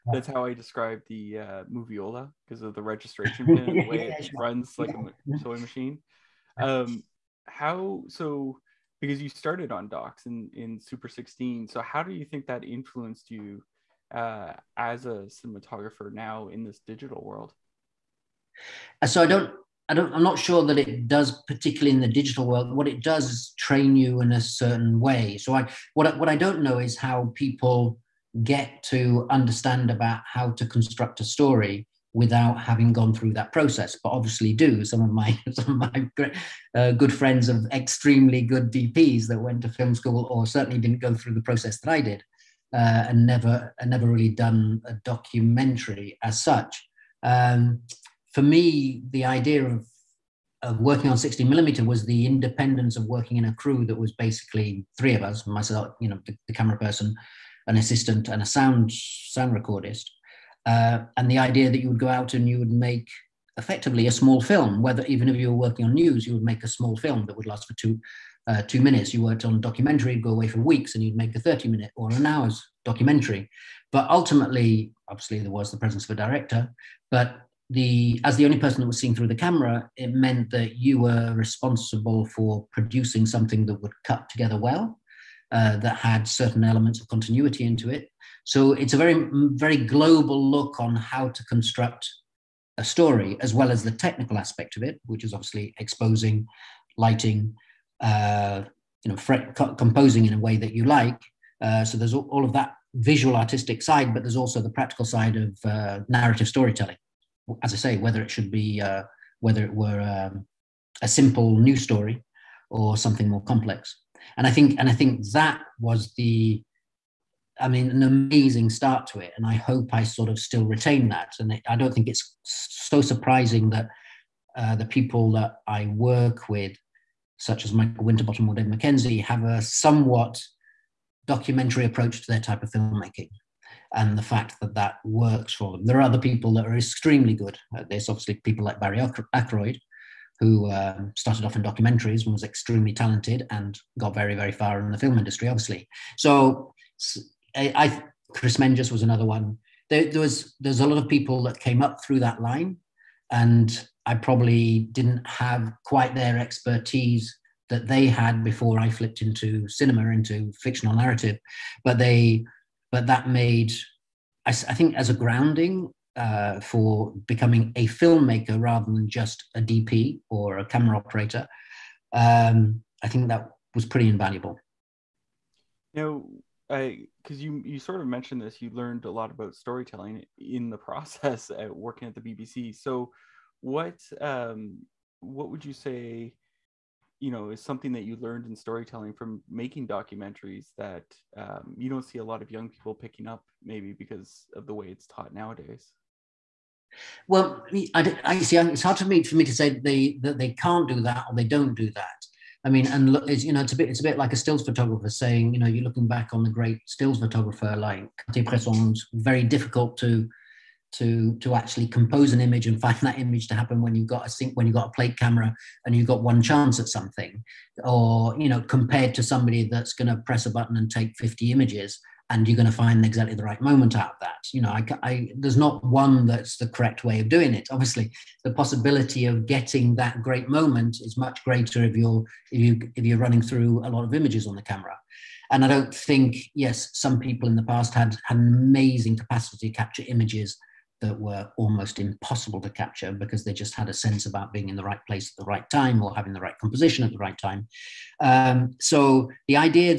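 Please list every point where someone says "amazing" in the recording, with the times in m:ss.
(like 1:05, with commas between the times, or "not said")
1:58, 3:58.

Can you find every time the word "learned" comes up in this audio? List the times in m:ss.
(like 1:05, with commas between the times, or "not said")
2:58, 3:08.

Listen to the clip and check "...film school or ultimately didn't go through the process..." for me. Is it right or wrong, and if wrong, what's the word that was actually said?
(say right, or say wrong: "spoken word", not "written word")
wrong: "certainly", not "ultimately".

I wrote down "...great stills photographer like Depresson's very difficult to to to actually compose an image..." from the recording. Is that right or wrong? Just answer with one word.
right.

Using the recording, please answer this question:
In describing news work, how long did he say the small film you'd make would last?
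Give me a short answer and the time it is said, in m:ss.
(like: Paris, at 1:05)
2 minutes, at 1:08.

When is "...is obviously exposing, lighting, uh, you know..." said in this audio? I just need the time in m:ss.
1:35.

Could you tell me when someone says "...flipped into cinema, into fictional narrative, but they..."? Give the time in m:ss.
2:38.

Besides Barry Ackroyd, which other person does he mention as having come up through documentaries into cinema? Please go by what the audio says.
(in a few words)
Chris Menges.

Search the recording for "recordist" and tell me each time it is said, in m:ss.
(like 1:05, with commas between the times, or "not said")
0:59.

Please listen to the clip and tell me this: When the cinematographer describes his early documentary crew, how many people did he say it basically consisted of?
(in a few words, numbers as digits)
3.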